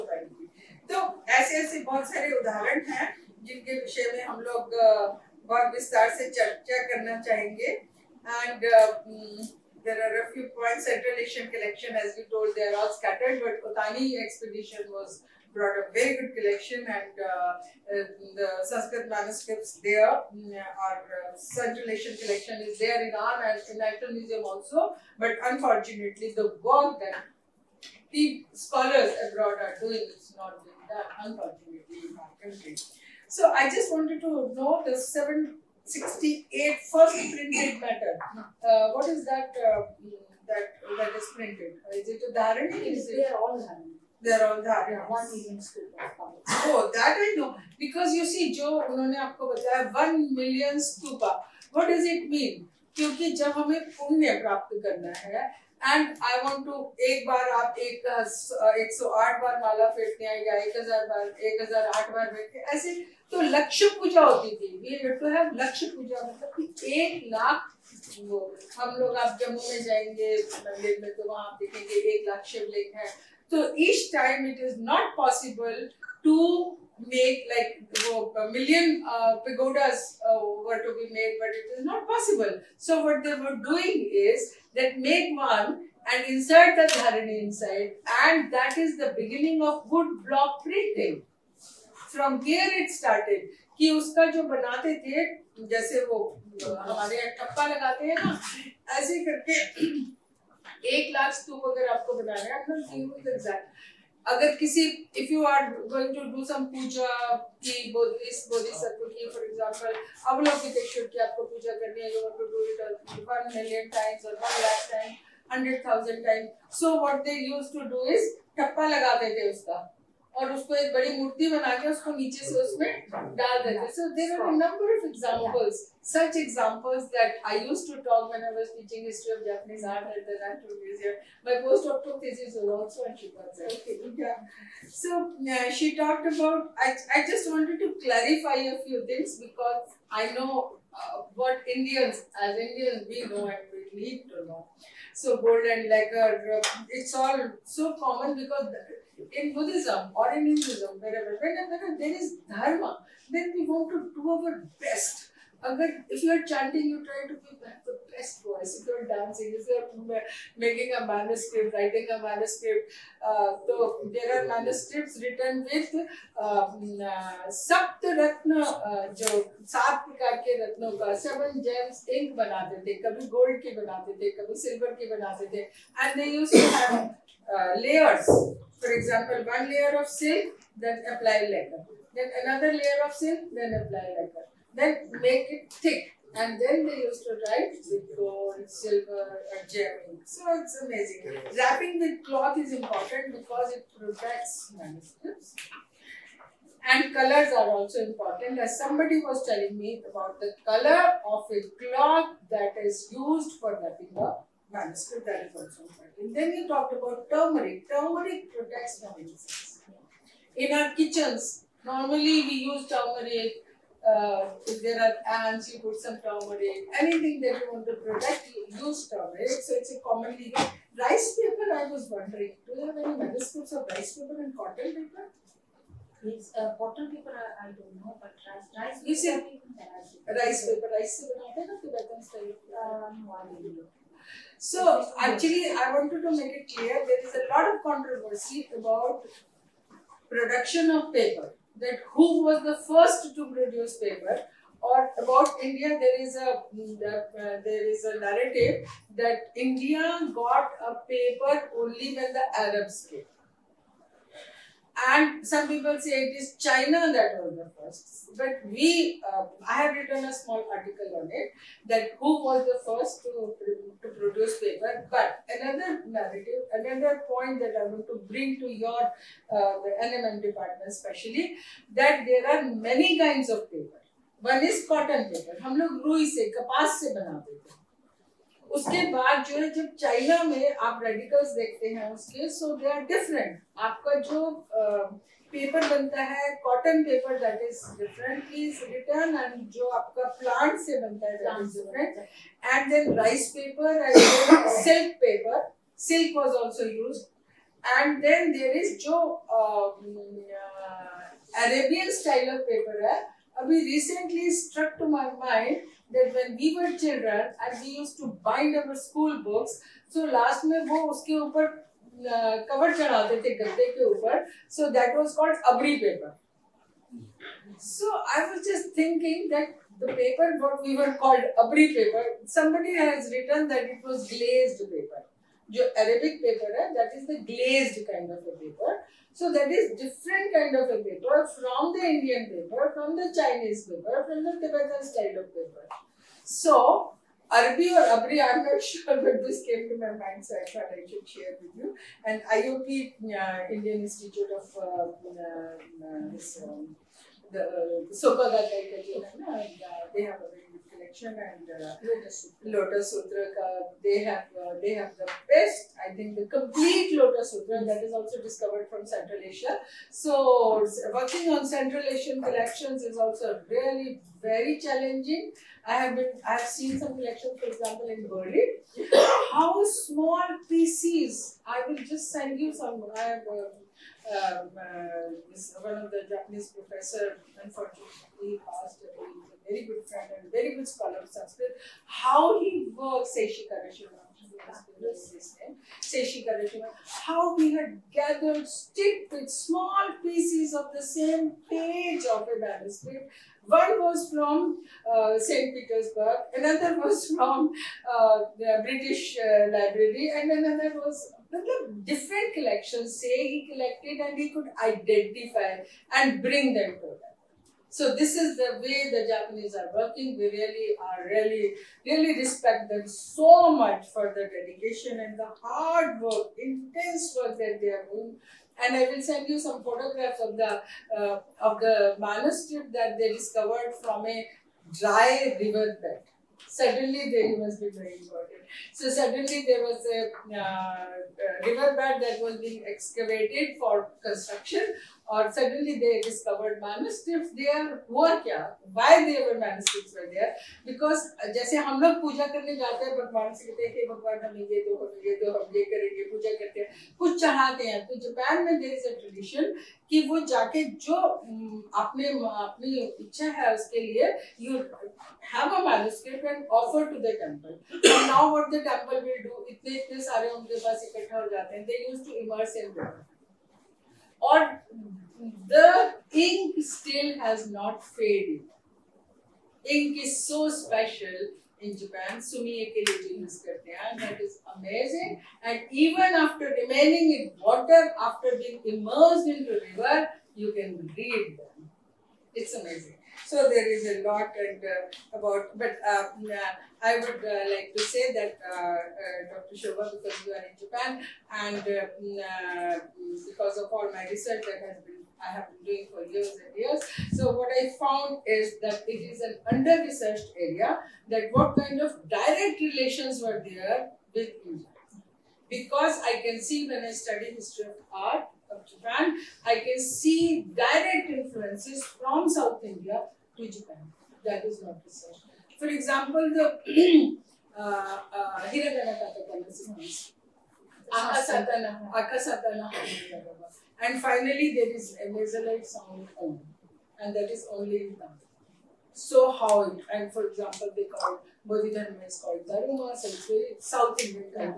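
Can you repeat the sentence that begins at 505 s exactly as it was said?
Because I can see when I study history of art of Japan, I can see direct influences from South India to Japan.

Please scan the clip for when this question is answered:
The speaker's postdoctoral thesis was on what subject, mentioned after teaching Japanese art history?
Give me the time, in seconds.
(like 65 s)
133 s.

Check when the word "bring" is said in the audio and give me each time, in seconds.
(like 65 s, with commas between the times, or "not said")
268 s, 406 s.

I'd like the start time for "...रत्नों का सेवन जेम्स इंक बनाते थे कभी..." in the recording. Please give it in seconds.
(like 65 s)
170 s.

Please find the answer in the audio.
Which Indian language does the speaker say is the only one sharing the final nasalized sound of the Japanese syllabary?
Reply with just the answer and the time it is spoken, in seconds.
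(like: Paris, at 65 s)
Tamil, at 528 s.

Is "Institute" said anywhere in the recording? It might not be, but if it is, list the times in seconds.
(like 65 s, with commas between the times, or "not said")
344 s.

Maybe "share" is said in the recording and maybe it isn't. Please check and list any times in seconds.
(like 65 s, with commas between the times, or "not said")
341 s.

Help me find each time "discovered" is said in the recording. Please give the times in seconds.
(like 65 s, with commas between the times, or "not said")
358 s, 423 s.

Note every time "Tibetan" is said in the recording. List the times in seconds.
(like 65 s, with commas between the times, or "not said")
334 s.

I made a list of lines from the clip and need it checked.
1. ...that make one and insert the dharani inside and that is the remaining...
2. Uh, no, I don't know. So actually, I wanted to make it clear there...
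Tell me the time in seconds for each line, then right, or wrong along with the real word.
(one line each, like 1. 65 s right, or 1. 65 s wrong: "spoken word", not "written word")
1. 84 s wrong: "beginning", not "remaining"
2. 231 s right.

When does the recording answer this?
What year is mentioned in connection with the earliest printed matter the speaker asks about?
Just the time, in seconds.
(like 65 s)
34 s.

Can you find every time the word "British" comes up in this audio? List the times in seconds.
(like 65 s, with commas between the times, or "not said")
398 s.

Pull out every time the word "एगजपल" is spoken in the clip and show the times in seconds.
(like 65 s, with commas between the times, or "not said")
109 s, 178 s.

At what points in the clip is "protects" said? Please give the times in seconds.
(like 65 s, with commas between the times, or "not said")
193 s, 208 s, 217 s.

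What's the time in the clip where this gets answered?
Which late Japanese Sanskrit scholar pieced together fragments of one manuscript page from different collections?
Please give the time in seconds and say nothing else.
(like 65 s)
383 s.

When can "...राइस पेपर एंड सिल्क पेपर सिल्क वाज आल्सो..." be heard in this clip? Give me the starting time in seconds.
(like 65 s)
293 s.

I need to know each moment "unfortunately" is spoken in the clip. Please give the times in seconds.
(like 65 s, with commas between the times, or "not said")
25 s, 31 s, 377 s.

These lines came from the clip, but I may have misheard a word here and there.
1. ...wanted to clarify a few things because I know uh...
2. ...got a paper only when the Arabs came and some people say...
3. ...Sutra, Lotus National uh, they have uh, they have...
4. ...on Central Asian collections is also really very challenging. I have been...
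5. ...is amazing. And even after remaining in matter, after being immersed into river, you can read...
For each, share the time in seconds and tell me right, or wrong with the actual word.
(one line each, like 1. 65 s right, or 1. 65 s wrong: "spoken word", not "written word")
1. 137 s right
2. 250 s right
3. 352 s wrong: "Sutra", not "National"
4. 361 s right
5. 474 s wrong: "water", not "matter".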